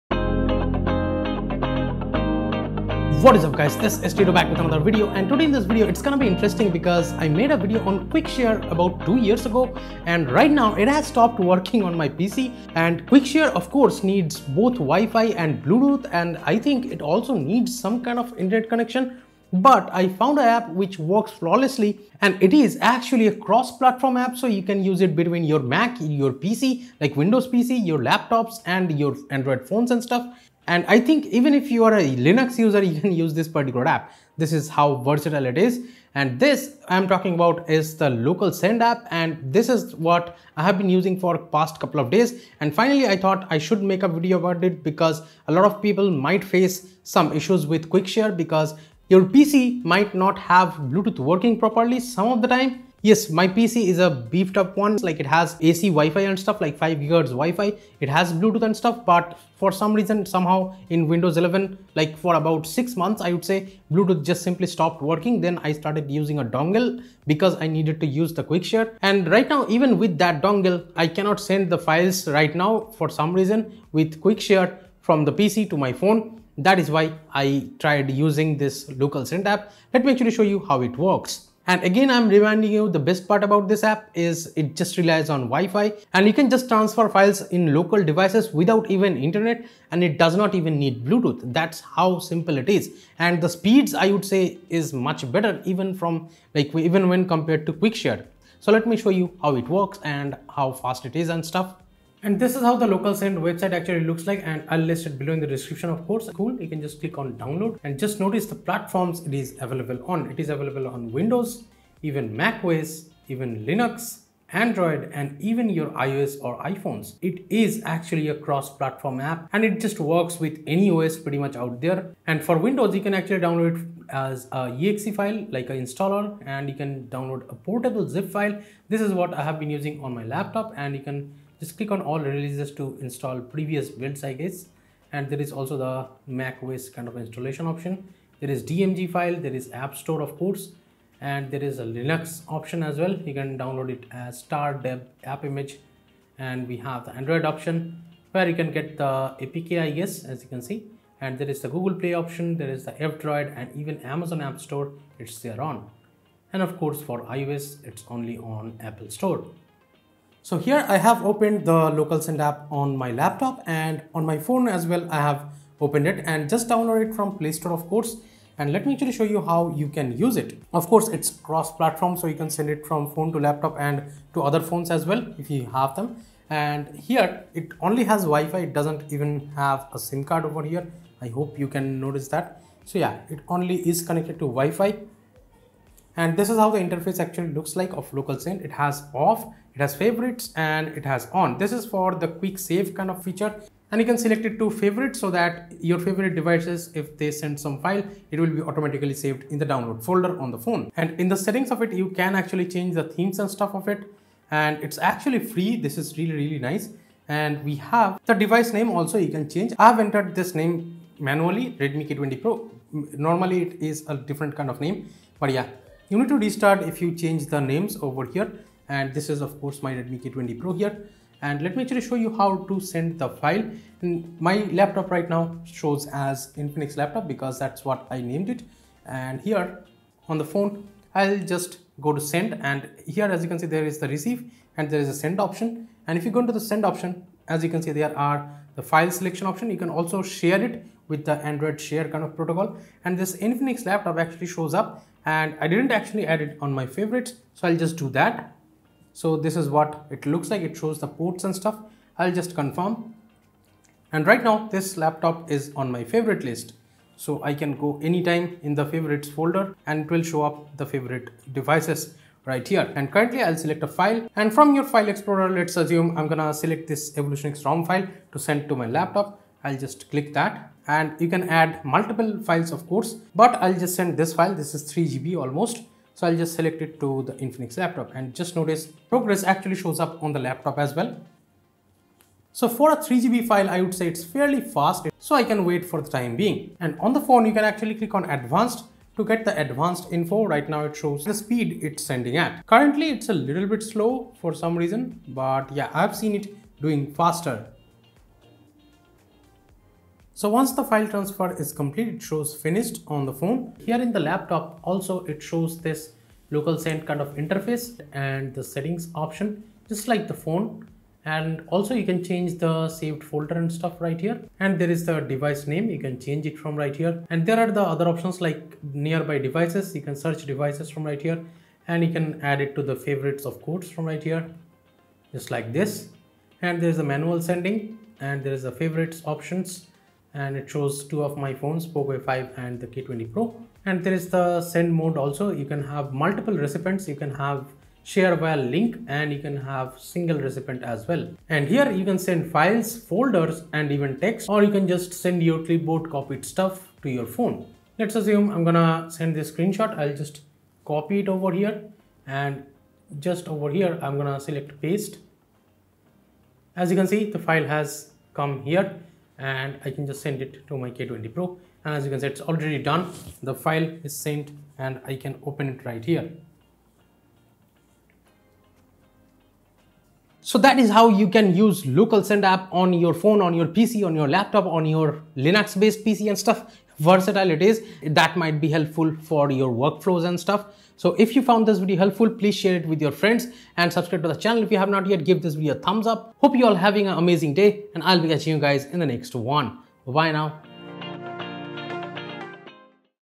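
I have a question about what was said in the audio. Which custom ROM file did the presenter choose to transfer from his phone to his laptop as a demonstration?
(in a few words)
EvolutionX.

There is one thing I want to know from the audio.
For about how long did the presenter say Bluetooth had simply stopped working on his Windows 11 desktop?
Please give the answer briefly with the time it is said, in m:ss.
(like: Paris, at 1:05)
6 months, at 1:02.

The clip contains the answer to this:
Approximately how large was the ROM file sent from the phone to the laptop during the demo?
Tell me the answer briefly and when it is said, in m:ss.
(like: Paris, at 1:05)
3 GB, at 4:34.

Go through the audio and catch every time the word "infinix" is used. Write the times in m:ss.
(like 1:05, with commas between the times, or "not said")
3:46, 4:03, 4:37.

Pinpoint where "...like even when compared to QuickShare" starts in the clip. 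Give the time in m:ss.
1:36.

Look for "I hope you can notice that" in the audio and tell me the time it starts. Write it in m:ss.
3:01.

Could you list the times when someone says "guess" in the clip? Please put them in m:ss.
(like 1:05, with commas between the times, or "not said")
2:14, 2:29.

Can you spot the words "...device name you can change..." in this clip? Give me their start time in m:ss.
5:15.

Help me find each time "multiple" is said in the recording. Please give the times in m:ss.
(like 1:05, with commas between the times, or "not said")
4:31, 5:36.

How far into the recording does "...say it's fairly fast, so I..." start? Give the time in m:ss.
4:43.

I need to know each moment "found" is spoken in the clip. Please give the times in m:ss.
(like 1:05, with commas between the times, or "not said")
0:20, 6:21.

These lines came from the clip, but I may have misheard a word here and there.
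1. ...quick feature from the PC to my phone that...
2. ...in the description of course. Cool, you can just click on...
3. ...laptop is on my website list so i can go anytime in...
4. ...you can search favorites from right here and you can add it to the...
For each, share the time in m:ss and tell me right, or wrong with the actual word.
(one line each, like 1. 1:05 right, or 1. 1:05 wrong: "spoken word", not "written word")
1. 1:14 wrong: "share", not "feature"
2. 1:45 right
3. 4:14 wrong: "favorite", not "website"
4. 5:19 wrong: "devices", not "favorites".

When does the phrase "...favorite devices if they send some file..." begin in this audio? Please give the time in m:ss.
3:15.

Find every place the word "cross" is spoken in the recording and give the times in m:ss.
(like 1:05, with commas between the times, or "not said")
0:23, 1:58, 2:51.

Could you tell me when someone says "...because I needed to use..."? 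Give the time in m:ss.
1:07.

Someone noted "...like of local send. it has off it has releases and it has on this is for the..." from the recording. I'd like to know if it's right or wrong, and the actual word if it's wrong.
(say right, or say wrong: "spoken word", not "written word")
wrong: "favorites", not "releases".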